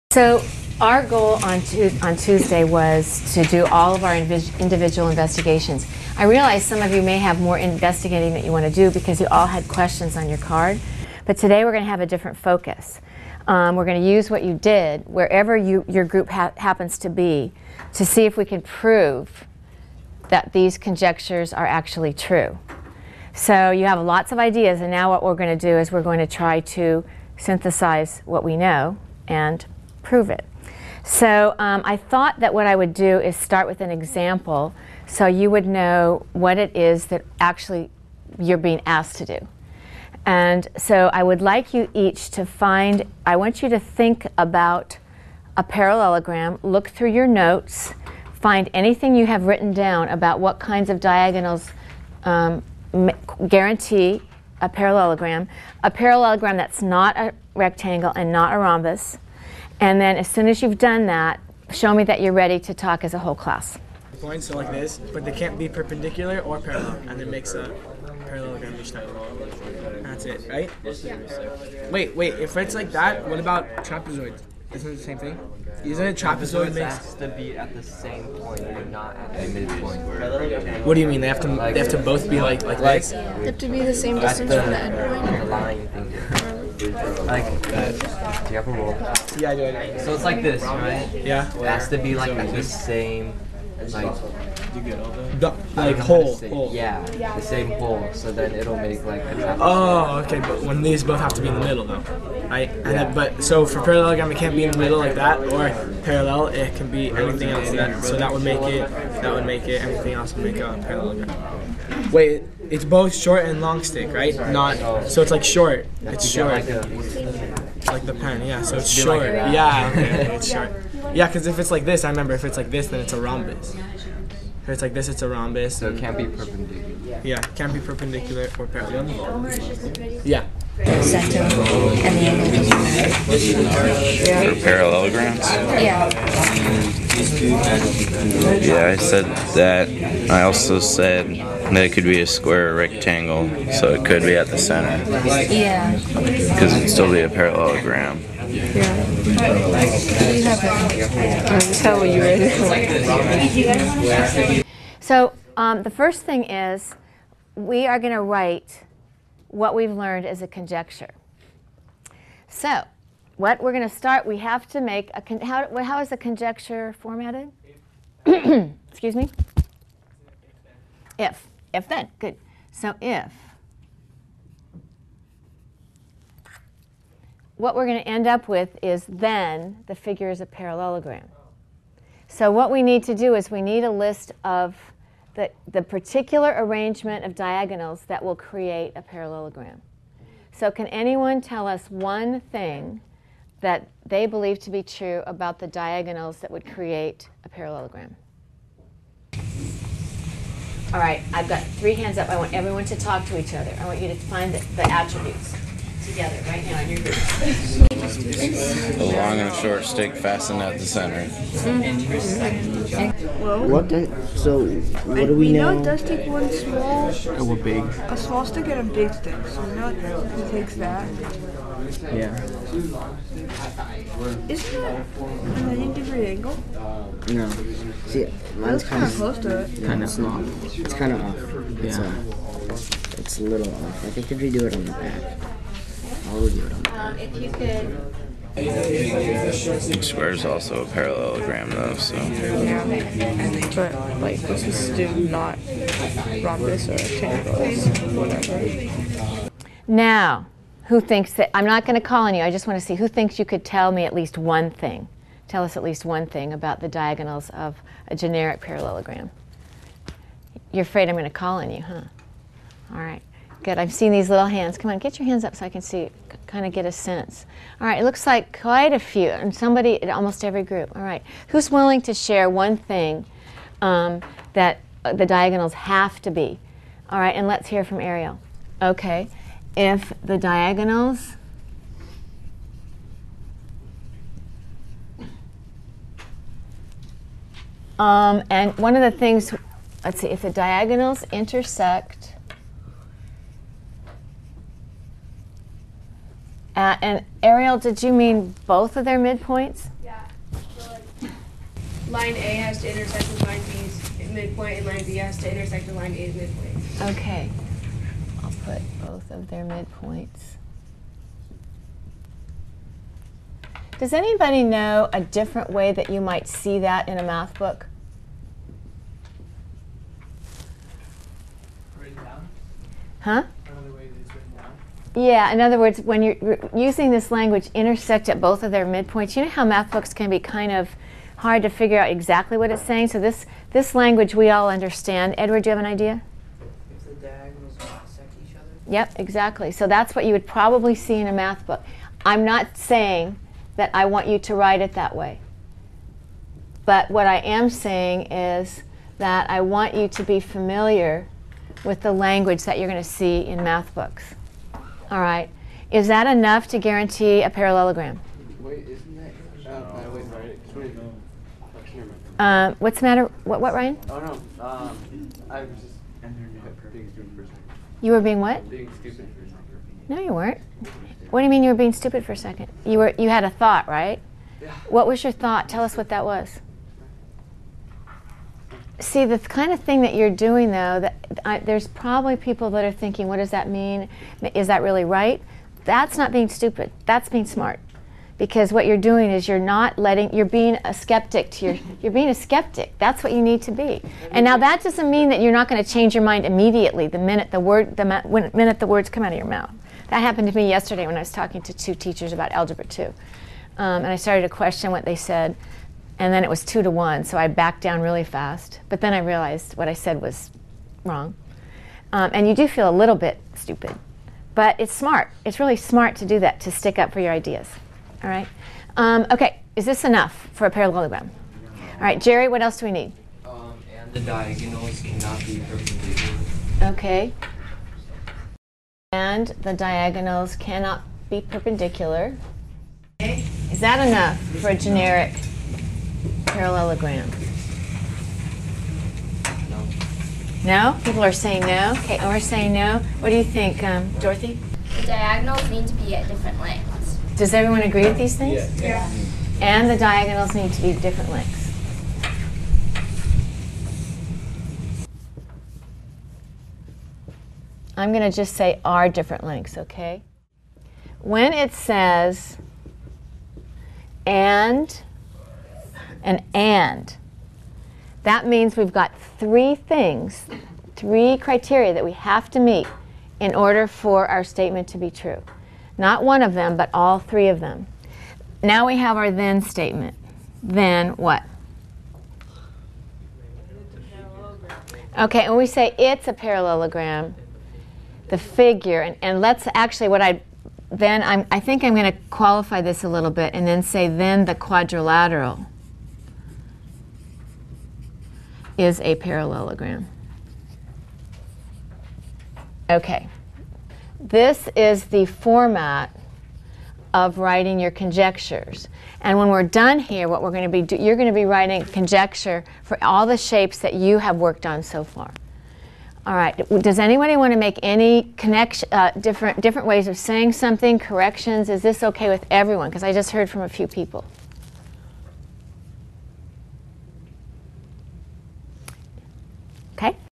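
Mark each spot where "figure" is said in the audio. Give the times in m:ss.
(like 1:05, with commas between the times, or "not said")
2:59, 5:31, 8:08.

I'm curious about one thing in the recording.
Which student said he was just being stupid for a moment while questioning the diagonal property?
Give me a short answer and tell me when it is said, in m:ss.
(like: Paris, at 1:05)
Ryan, at 6:03.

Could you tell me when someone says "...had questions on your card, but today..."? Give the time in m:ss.
0:09.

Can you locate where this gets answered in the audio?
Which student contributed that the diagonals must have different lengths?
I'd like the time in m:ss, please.
7:24.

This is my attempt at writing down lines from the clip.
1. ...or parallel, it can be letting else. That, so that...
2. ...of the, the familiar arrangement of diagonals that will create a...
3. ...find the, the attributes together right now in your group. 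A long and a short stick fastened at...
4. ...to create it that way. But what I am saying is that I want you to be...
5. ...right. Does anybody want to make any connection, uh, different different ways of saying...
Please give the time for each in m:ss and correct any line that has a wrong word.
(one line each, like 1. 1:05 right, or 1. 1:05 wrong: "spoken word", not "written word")
1. 1:45 wrong: "anything", not "letting"
2. 3:04 wrong: "particular", not "familiar"
3. 3:24 right
4. 5:44 wrong: "write", not "create"
5. 8:36 right.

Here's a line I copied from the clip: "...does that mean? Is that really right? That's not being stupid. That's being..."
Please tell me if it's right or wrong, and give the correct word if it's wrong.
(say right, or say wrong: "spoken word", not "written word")
right.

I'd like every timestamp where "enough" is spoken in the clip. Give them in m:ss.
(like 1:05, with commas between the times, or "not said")
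5:56, 7:00, 7:14.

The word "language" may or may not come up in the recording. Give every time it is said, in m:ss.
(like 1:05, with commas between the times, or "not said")
5:27, 5:33, 5:52.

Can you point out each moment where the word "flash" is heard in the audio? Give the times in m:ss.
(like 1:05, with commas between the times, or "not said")
not said.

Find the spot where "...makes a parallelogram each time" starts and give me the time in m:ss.
1:07.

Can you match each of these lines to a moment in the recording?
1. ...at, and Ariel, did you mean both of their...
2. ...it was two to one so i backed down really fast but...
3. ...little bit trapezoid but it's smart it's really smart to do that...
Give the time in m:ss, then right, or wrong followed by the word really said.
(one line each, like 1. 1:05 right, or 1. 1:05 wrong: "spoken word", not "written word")
1. 4:56 right
2. 6:46 right
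3. 6:52 wrong: "stupid", not "trapezoid".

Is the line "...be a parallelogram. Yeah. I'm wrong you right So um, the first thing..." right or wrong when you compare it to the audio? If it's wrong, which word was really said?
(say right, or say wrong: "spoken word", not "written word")
wrong: "telling", not "wrong".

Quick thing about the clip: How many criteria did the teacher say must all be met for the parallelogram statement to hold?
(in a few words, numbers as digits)
3.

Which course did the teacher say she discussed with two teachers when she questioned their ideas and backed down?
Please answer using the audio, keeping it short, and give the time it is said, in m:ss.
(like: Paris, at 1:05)
Algebra 2, at 6:42.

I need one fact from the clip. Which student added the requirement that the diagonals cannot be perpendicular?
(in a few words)
Jerry.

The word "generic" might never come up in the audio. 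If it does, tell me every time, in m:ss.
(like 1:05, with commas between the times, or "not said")
4:18, 7:14.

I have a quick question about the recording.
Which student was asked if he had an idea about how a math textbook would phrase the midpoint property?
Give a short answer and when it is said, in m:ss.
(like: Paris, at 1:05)
Edward, at 5:35.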